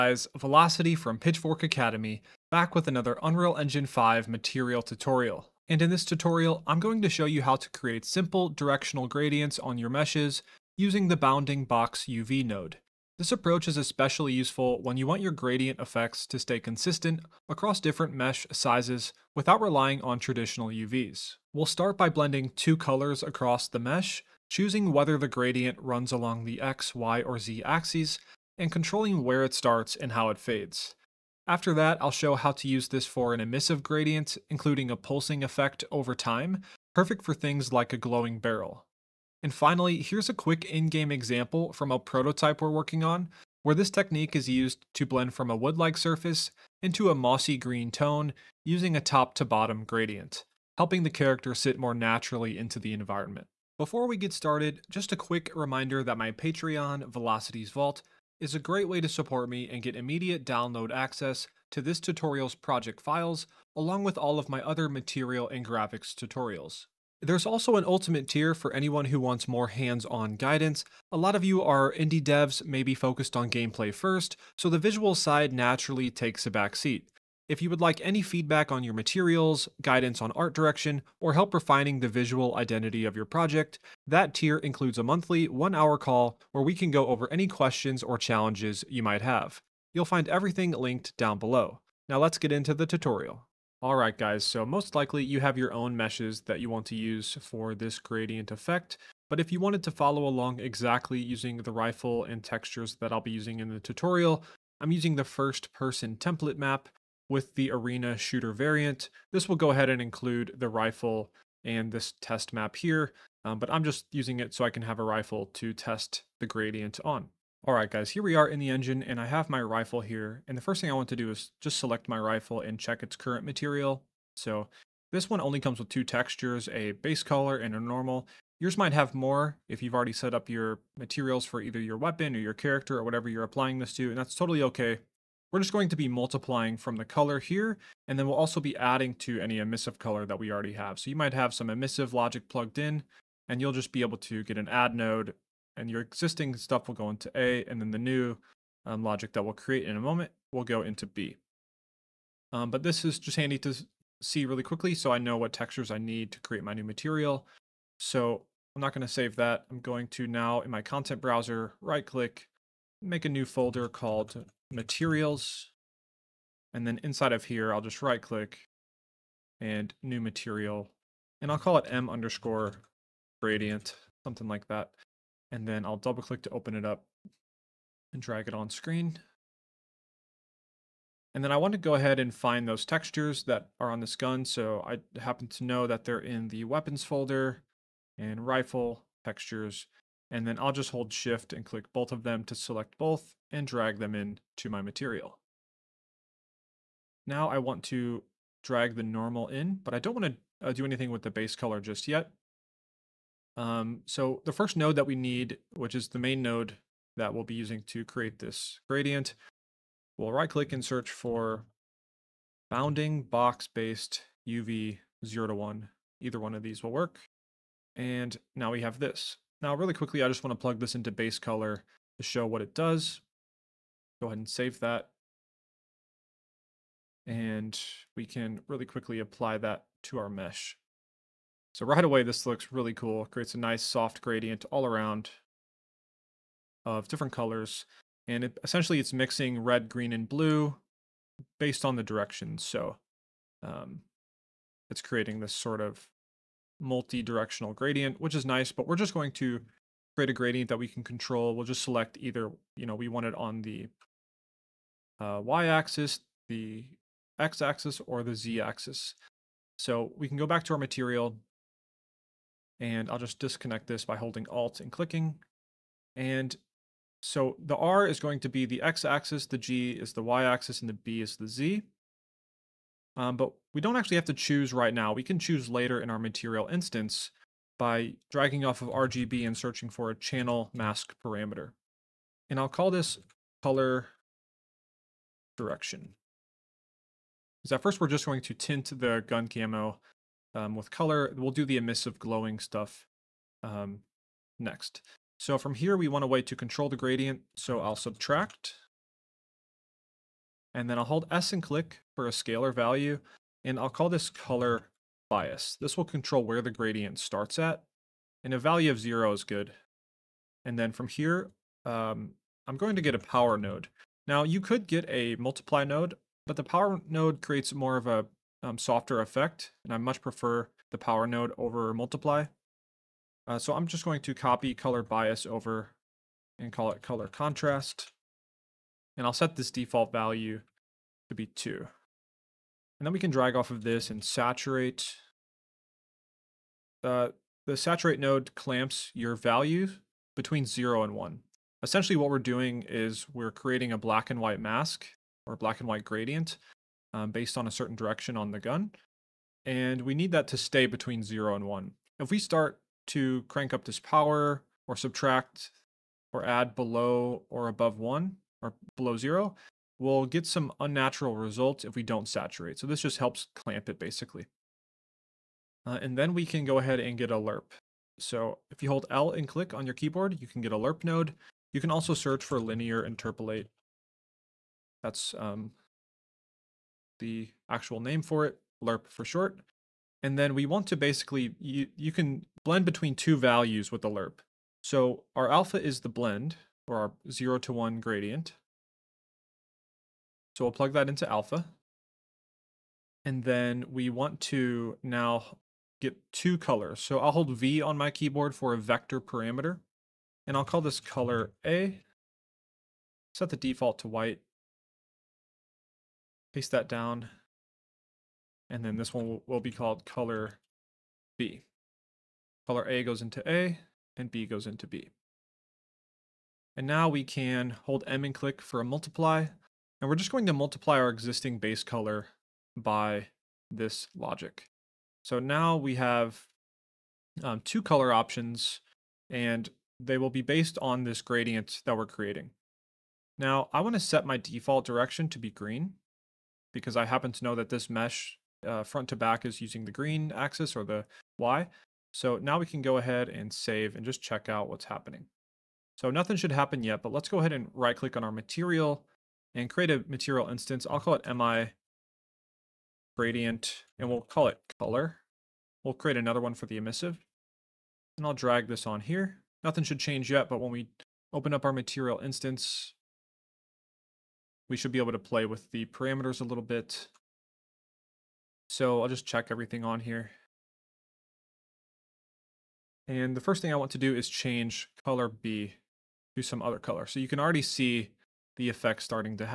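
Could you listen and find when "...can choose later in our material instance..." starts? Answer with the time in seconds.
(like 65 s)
275 s.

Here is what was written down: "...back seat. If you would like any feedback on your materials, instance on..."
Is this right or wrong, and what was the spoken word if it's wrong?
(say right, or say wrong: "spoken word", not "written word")
wrong: "guidance", not "instance".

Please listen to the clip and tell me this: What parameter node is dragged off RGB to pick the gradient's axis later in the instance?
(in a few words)
channel mask parameter.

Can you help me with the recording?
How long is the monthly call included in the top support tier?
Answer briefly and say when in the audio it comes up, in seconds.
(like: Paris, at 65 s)
one hour, at 85 s.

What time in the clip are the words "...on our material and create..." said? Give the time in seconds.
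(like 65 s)
448 s.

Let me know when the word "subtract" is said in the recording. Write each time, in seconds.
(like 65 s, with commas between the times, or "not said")
297 s, 354 s.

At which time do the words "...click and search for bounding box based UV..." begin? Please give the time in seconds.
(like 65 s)
210 s.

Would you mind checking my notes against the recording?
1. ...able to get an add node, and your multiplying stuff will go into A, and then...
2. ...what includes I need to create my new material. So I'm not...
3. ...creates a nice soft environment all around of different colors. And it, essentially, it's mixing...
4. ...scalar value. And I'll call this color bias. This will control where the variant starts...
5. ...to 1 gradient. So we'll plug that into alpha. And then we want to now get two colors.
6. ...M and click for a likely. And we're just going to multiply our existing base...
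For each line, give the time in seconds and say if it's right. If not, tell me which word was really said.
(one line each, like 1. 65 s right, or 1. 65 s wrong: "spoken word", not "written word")
1. 144 s wrong: "existing", not "multiplying"
2. 155 s wrong: "textures", not "includes"
3. 233 s wrong: "gradient", not "environment"
4. 302 s wrong: "gradient", not "variant"
5. 387 s right
6. 418 s wrong: "multiply", not "likely".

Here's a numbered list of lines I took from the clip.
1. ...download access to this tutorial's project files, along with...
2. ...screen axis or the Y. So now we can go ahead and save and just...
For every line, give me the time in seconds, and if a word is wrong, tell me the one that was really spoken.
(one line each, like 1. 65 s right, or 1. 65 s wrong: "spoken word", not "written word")
1. 60 s right
2. 439 s wrong: "green", not "screen".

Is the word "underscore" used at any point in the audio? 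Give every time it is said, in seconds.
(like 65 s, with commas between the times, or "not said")
172 s.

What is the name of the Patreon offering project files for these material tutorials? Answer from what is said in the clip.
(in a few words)
Vylocity's Vault.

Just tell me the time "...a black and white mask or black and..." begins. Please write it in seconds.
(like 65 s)
343 s.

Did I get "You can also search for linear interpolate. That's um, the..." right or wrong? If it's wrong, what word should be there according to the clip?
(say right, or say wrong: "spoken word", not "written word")
right.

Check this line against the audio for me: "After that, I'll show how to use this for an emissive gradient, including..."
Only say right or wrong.
right.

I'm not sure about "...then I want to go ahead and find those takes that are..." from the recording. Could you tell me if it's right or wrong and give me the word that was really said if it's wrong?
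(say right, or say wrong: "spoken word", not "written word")
wrong: "textures", not "takes".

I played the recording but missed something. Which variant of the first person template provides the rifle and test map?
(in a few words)
arena shooter.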